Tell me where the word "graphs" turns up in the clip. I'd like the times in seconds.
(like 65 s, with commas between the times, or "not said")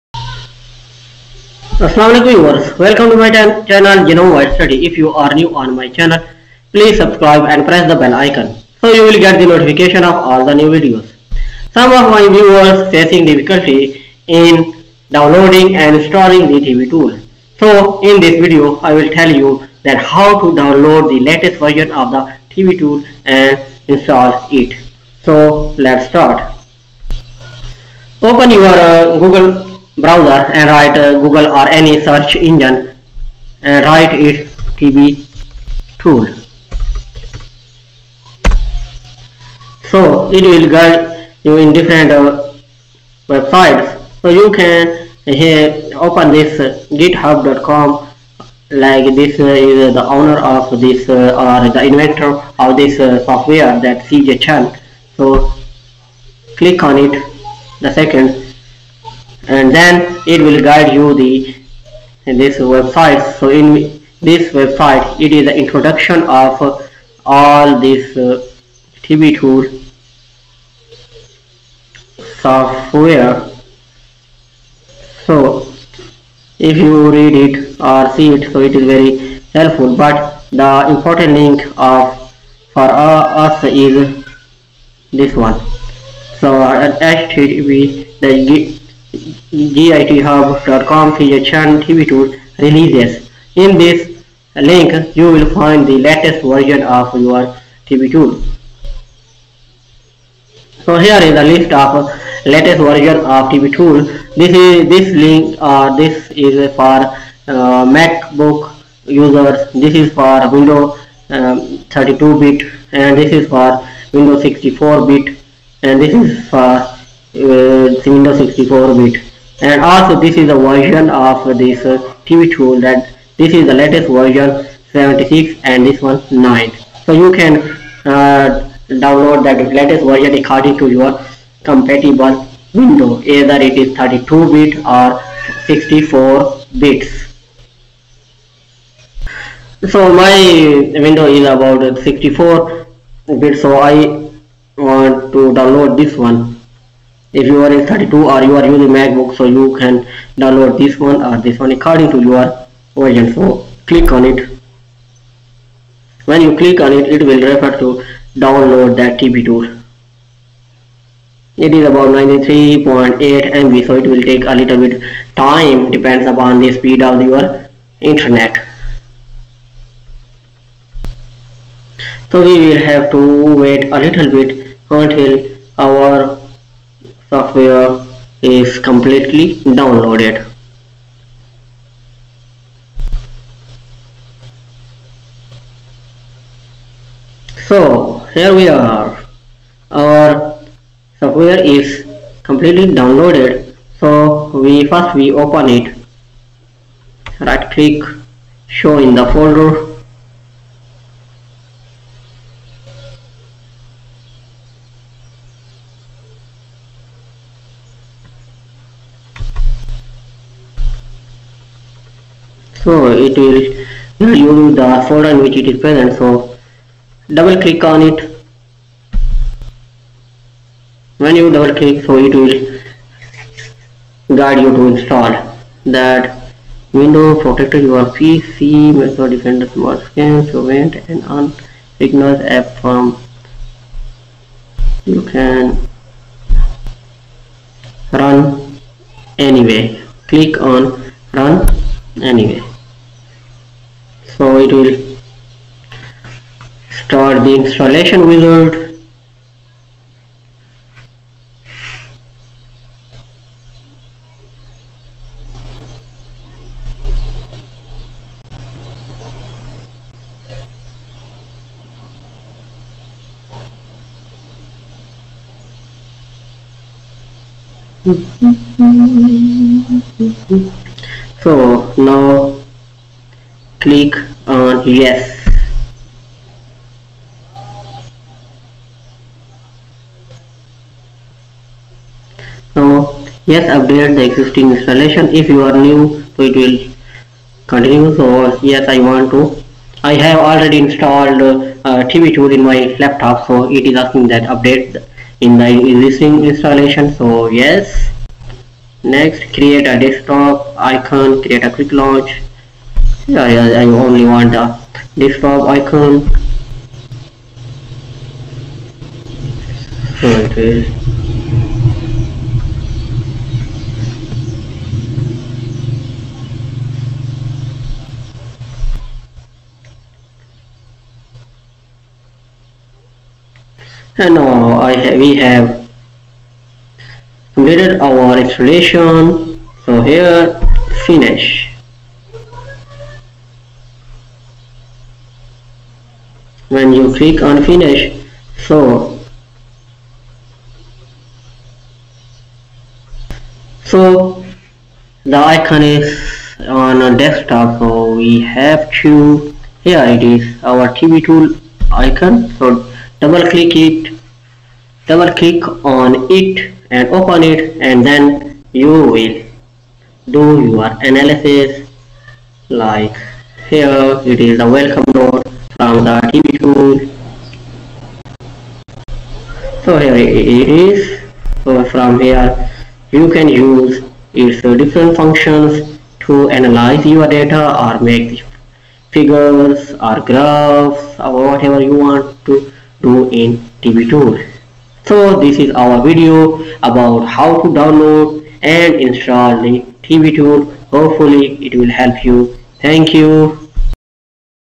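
380 s.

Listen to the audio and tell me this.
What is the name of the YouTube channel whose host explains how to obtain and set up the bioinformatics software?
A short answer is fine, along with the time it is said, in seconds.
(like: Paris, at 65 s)
Genome Wide Study, at 4 s.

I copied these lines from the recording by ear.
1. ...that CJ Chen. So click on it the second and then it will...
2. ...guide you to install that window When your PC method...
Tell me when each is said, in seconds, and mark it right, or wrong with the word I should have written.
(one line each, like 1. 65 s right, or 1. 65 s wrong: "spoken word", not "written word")
1. 53 s right
2. 224 s wrong: "Protected", not "When".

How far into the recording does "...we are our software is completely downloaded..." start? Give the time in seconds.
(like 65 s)
188 s.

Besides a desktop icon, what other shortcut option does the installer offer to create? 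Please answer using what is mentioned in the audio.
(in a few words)
Quick launch.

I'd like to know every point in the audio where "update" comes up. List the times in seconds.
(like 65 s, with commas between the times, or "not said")
283 s, 294 s.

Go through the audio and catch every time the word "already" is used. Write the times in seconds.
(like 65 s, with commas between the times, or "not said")
290 s.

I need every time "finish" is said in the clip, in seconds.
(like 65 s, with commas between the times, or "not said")
331 s, 337 s.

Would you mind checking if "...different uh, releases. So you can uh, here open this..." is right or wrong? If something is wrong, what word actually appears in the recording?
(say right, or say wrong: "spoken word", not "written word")
wrong: "websites", not "releases".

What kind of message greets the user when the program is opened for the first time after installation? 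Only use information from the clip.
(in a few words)
Welcome note.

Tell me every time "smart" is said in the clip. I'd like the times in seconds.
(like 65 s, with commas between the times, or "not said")
229 s.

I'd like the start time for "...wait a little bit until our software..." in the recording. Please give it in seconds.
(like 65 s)
173 s.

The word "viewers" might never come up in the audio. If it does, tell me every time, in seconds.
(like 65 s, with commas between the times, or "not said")
2 s, 12 s.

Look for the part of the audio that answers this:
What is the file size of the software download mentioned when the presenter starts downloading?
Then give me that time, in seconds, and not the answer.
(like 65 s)
162 s.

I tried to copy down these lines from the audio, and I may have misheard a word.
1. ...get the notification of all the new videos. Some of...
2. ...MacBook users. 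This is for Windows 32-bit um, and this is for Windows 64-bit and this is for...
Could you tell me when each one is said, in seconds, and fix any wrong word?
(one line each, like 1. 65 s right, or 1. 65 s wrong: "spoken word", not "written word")
1. 9 s right
2. 107 s right.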